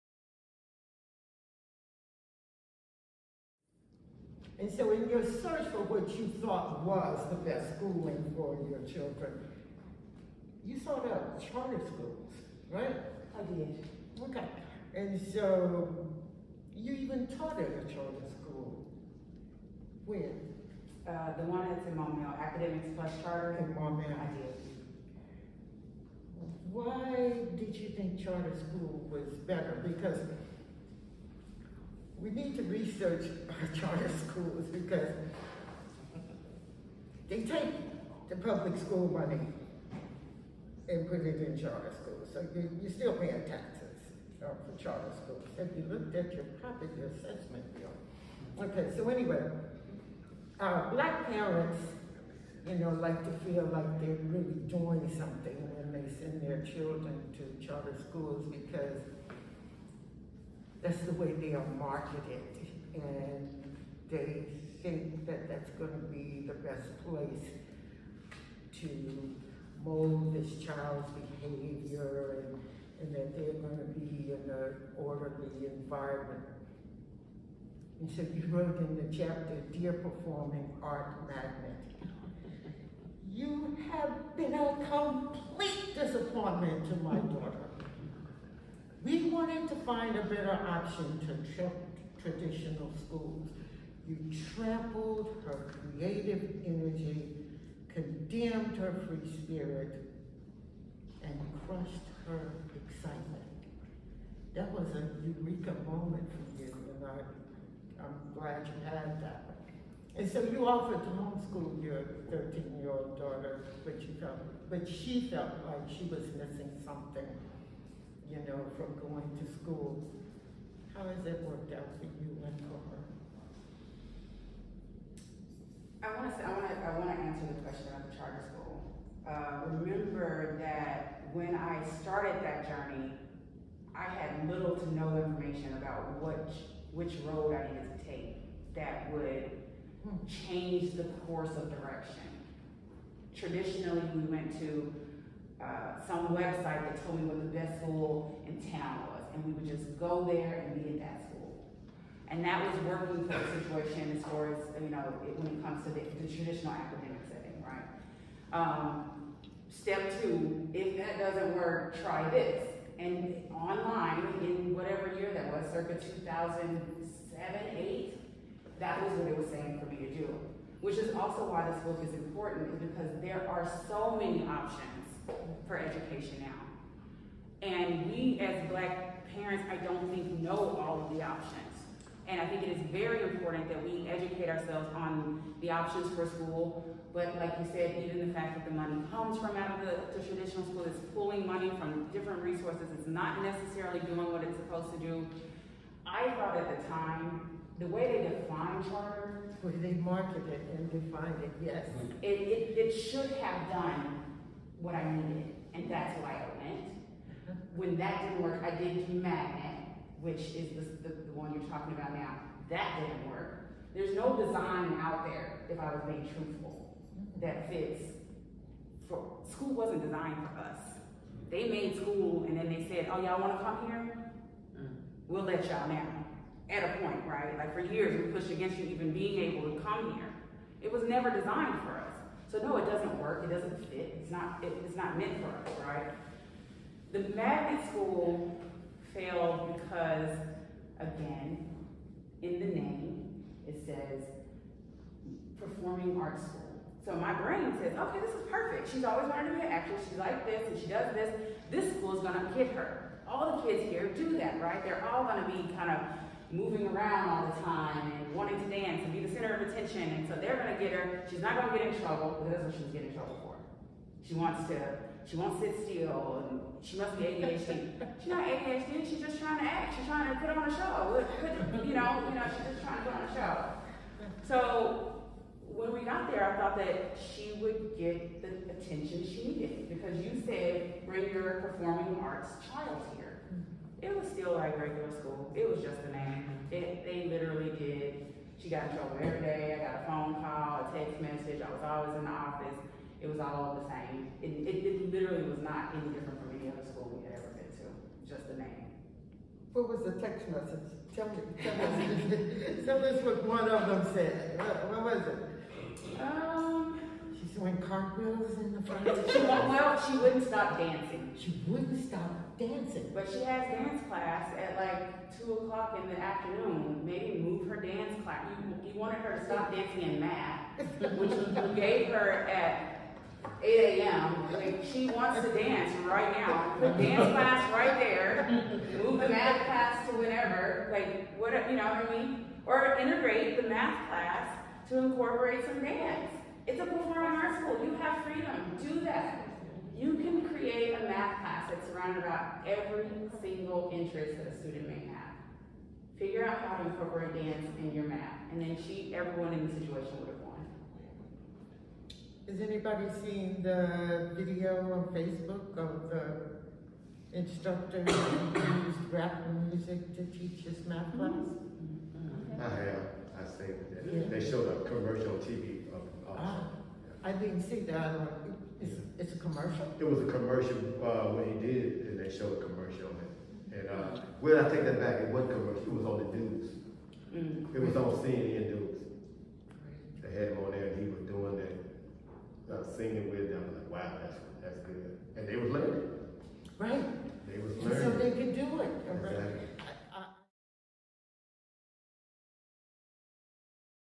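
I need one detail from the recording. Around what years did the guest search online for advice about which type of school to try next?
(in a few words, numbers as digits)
2007, 8.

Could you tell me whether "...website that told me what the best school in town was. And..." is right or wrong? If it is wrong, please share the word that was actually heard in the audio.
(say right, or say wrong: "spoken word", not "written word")
right.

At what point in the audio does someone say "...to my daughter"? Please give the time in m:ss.
1:26.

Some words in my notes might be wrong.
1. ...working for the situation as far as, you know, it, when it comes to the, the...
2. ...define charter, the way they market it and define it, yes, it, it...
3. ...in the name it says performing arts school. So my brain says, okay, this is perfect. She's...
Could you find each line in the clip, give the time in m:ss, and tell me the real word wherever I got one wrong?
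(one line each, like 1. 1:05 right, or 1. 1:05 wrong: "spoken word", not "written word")
1. 2:32 right
2. 3:18 right
3. 4:02 right.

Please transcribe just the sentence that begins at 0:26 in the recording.
Why did you think charter school was better?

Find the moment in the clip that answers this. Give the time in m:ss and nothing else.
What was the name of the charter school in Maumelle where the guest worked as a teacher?
0:22.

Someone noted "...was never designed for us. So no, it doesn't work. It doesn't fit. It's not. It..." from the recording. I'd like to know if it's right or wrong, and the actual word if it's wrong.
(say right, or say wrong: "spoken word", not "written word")
right.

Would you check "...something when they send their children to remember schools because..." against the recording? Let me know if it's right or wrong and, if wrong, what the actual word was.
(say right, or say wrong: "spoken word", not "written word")
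wrong: "charter", not "remember".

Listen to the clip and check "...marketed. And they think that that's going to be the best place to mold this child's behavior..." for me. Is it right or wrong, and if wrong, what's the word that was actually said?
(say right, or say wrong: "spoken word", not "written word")
right.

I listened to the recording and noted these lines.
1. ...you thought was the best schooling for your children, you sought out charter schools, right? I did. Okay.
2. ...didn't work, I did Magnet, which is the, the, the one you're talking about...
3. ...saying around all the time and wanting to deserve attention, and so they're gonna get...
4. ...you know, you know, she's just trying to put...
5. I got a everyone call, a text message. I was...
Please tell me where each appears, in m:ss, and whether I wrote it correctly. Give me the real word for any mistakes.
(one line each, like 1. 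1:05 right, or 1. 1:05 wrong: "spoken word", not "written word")
1. 0:06 right
2. 3:28 right
3. 4:16 wrong: "moving", not "saying"
4. 4:31 right
5. 4:49 wrong: "phone", not "everyone".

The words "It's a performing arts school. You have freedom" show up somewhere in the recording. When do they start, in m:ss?
5:36.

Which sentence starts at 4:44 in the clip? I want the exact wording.
It was still like regular school.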